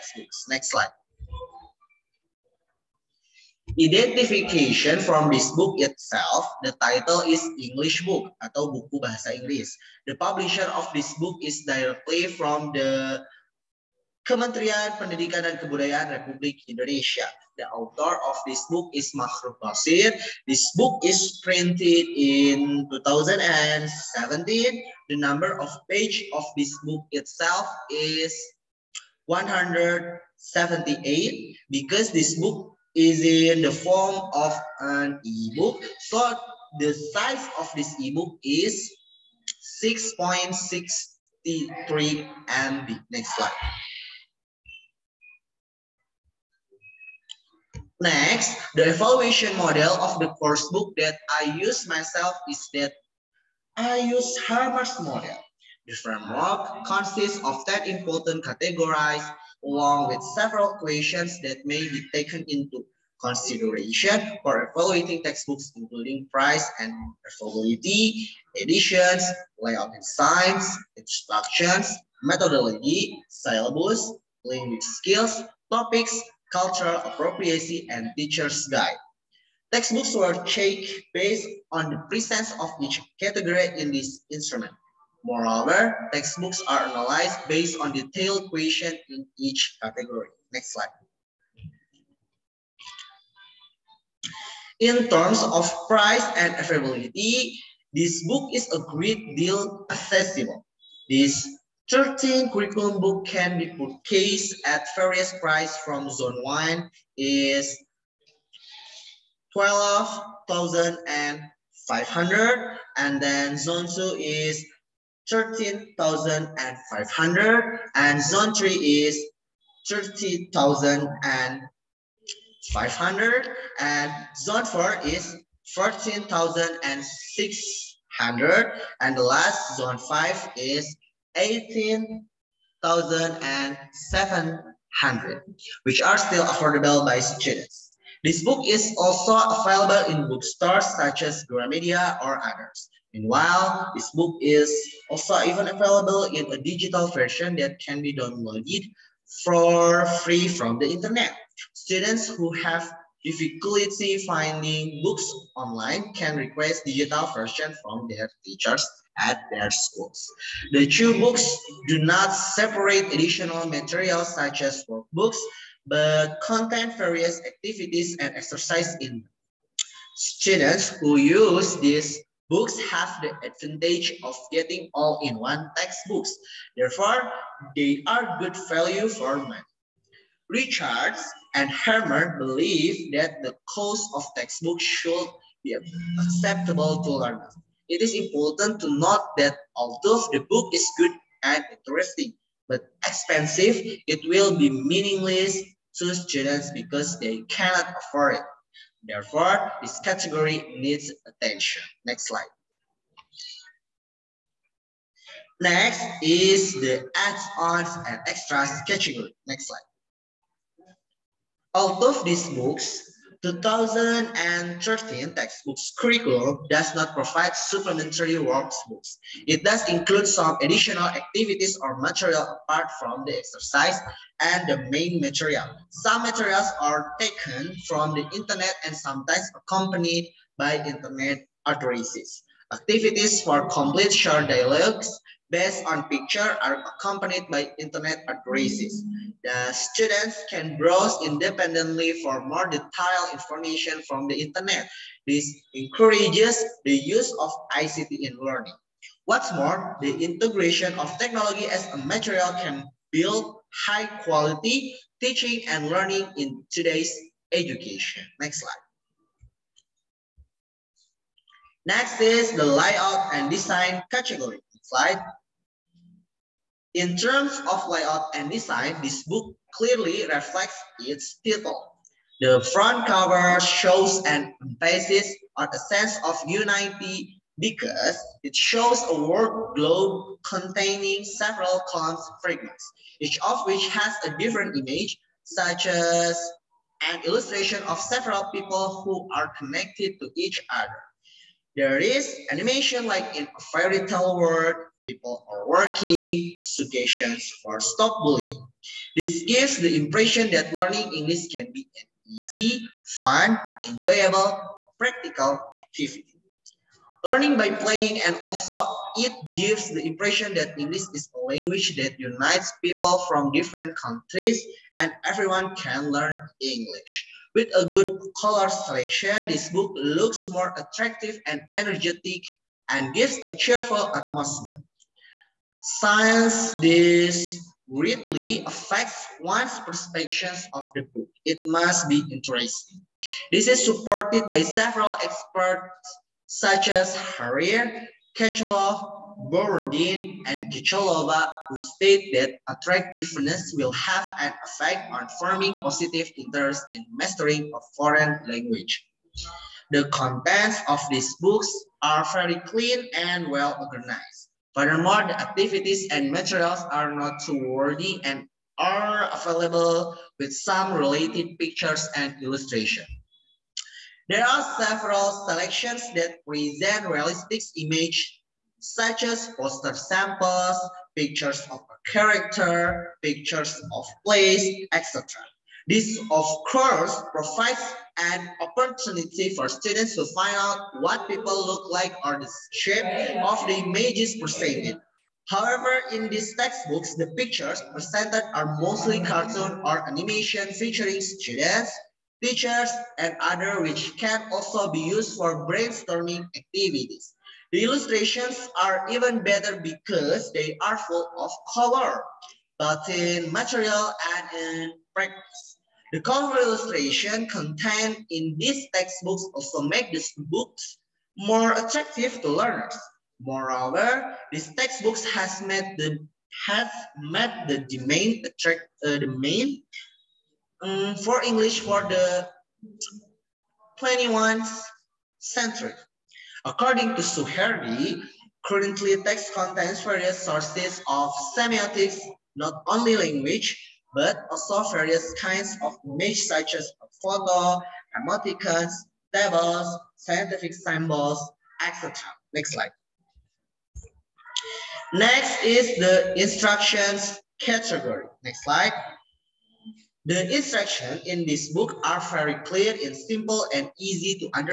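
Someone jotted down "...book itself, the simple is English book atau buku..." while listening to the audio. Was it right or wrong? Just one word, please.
wrong.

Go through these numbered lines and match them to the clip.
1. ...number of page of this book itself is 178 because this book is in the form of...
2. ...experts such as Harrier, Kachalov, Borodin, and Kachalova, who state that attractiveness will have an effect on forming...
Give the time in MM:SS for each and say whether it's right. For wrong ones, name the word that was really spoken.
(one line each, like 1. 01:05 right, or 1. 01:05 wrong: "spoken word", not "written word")
1. 00:25 right
2. 05:35 right.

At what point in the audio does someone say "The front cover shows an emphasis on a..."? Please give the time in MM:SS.
04:32.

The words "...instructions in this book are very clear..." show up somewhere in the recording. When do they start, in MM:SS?
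07:30.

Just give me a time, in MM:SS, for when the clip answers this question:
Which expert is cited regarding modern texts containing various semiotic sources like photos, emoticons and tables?
07:07.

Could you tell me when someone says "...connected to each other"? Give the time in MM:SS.
04:49.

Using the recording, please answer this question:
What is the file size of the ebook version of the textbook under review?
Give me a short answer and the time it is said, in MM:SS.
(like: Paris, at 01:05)
6.63 MB, at 00:39.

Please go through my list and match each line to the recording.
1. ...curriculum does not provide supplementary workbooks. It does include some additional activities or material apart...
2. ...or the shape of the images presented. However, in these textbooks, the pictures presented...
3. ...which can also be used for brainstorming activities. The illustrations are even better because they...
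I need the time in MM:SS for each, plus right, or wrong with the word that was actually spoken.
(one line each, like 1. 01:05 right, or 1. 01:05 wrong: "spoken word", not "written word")
1. 03:35 right
2. 06:22 right
3. 06:33 right.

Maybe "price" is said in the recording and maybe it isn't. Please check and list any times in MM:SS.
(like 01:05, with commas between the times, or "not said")
01:06, 01:35.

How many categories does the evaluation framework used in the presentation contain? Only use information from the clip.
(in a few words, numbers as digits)
10.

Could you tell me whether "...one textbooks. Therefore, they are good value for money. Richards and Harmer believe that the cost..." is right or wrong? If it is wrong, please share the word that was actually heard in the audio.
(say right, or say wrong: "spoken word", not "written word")
right.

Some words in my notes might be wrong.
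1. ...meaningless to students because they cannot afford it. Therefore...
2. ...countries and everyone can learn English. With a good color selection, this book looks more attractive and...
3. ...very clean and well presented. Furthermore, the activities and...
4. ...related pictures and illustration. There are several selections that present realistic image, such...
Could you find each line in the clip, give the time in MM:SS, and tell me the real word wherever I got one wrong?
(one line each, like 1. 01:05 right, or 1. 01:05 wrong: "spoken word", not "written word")
1. 03:14 right
2. 05:13 right
3. 05:52 wrong: "organized", not "presented"
4. 06:00 right.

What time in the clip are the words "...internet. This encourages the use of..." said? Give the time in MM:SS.
04:04.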